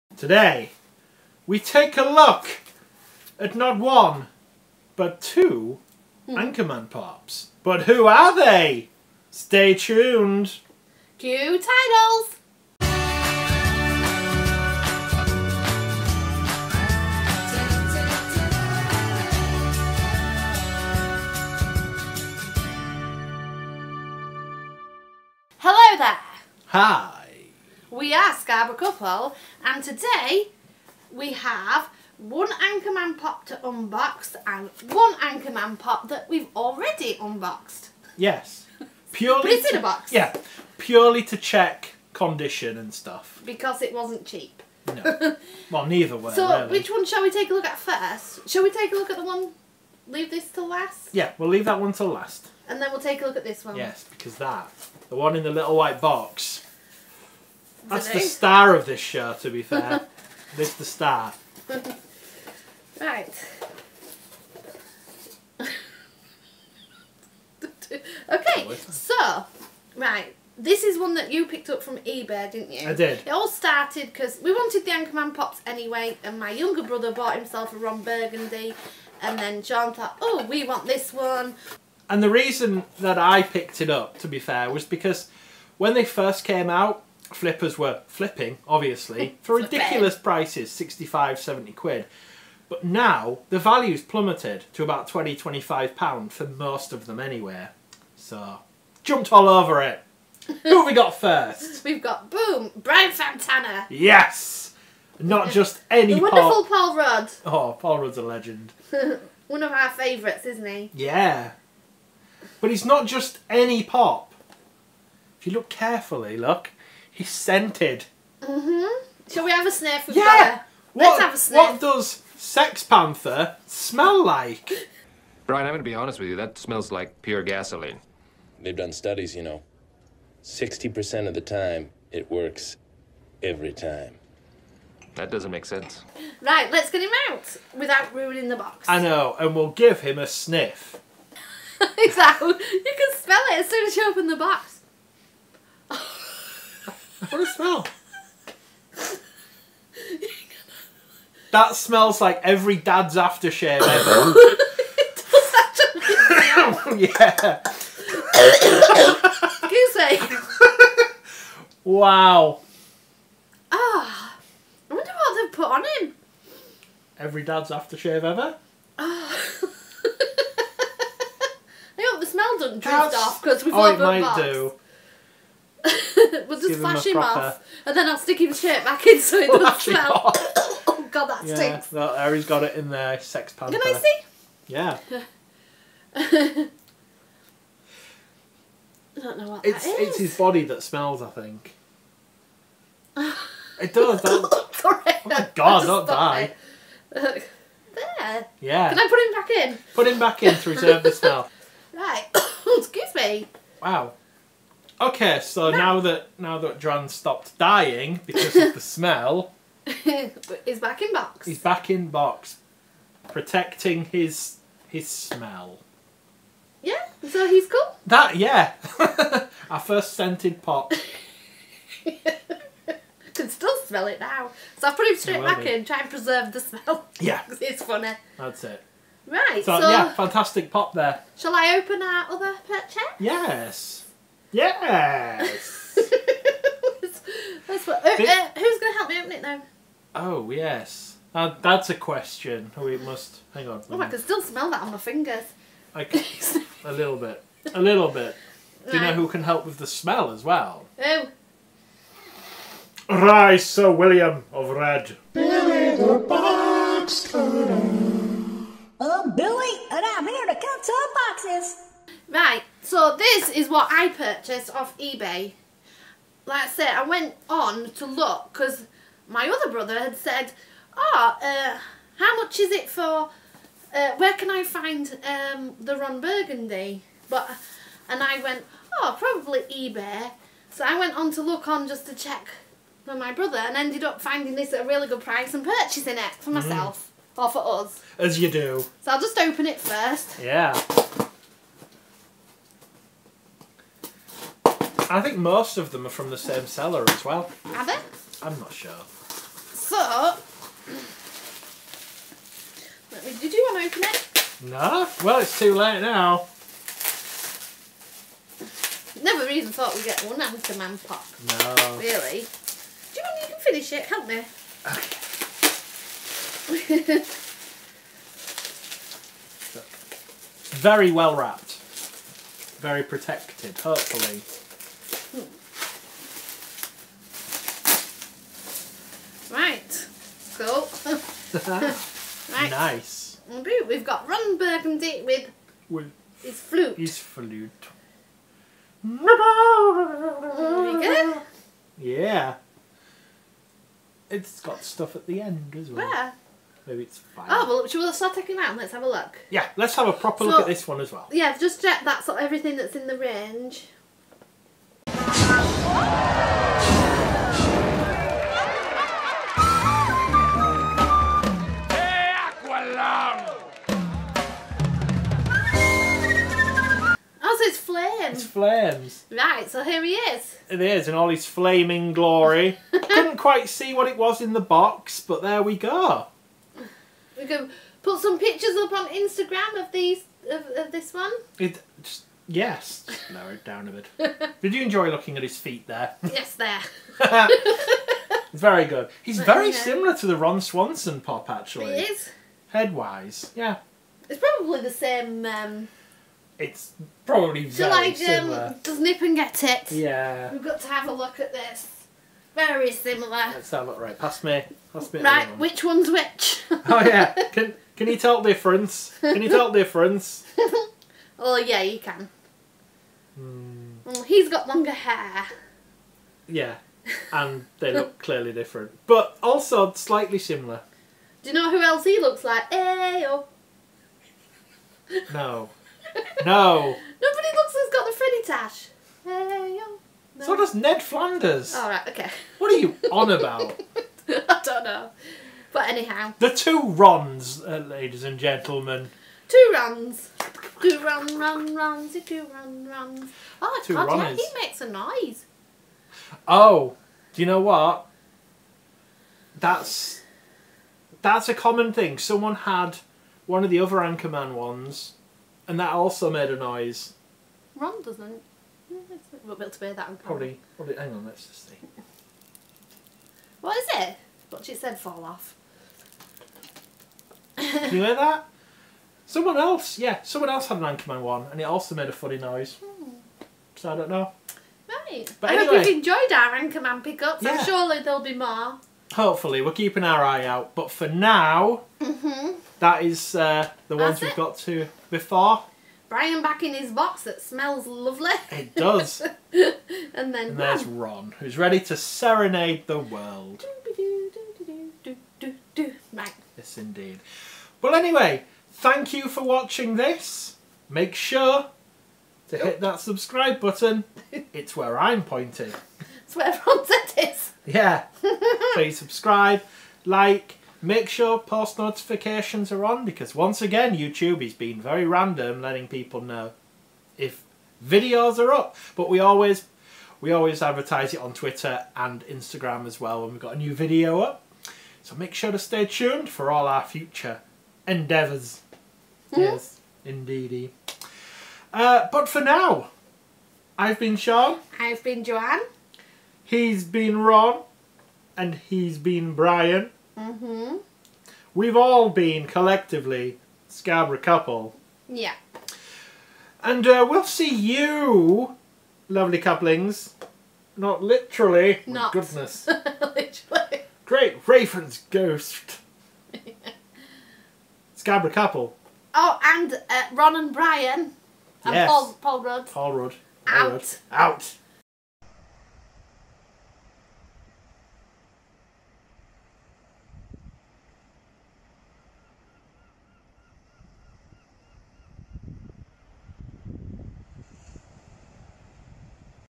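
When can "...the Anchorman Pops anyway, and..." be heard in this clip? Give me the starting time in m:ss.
1:14.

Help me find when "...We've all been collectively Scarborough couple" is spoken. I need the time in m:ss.
9:01.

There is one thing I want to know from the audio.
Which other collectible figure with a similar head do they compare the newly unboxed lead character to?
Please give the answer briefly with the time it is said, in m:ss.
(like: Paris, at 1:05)
Ron Swanson, at 6:30.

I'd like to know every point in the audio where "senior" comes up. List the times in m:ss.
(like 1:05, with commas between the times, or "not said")
not said.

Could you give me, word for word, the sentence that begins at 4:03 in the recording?
Oh, I can still smell that on my fingers.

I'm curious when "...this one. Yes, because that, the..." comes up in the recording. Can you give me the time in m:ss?
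0:53.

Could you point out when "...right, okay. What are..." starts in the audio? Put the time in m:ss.
7:11.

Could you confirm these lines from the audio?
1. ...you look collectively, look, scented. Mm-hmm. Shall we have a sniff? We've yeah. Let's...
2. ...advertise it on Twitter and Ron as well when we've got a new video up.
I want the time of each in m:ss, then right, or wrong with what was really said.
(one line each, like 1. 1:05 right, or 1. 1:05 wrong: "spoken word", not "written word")
1. 1:55 wrong: "carefully", not "collectively"
2. 8:40 wrong: "Instagram", not "Ron".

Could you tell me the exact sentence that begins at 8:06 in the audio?
Brian back in his box that smells lovely.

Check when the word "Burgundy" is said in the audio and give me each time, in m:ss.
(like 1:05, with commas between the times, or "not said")
1:18, 4:36, 5:34.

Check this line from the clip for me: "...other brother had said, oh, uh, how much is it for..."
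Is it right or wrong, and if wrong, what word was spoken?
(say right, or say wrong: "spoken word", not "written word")
right.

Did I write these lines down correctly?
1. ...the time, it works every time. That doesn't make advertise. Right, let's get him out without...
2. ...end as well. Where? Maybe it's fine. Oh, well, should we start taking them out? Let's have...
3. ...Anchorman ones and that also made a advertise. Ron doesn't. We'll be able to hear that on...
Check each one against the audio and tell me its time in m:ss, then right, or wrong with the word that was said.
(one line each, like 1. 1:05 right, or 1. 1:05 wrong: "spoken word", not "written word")
1. 2:11 wrong: "sense", not "advertise"
2. 5:45 right
3. 7:33 wrong: "noise", not "advertise".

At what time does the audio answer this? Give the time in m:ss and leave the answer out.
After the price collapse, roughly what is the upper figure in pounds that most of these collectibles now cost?
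1:35.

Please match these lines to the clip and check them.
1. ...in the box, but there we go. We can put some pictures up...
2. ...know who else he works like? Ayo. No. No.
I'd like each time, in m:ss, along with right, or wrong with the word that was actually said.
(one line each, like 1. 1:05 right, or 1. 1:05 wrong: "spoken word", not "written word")
1. 6:14 right
2. 7:01 wrong: "looks", not "works".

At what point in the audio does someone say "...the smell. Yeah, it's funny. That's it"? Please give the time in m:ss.
3:46.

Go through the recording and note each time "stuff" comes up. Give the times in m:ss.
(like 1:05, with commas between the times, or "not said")
0:42, 5:44.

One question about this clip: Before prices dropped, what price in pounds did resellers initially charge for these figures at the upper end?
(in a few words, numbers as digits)
70.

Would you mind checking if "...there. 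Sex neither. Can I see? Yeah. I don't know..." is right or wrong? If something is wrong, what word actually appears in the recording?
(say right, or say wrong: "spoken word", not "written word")
wrong: "panther", not "neither".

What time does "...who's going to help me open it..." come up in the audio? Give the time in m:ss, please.
3:58.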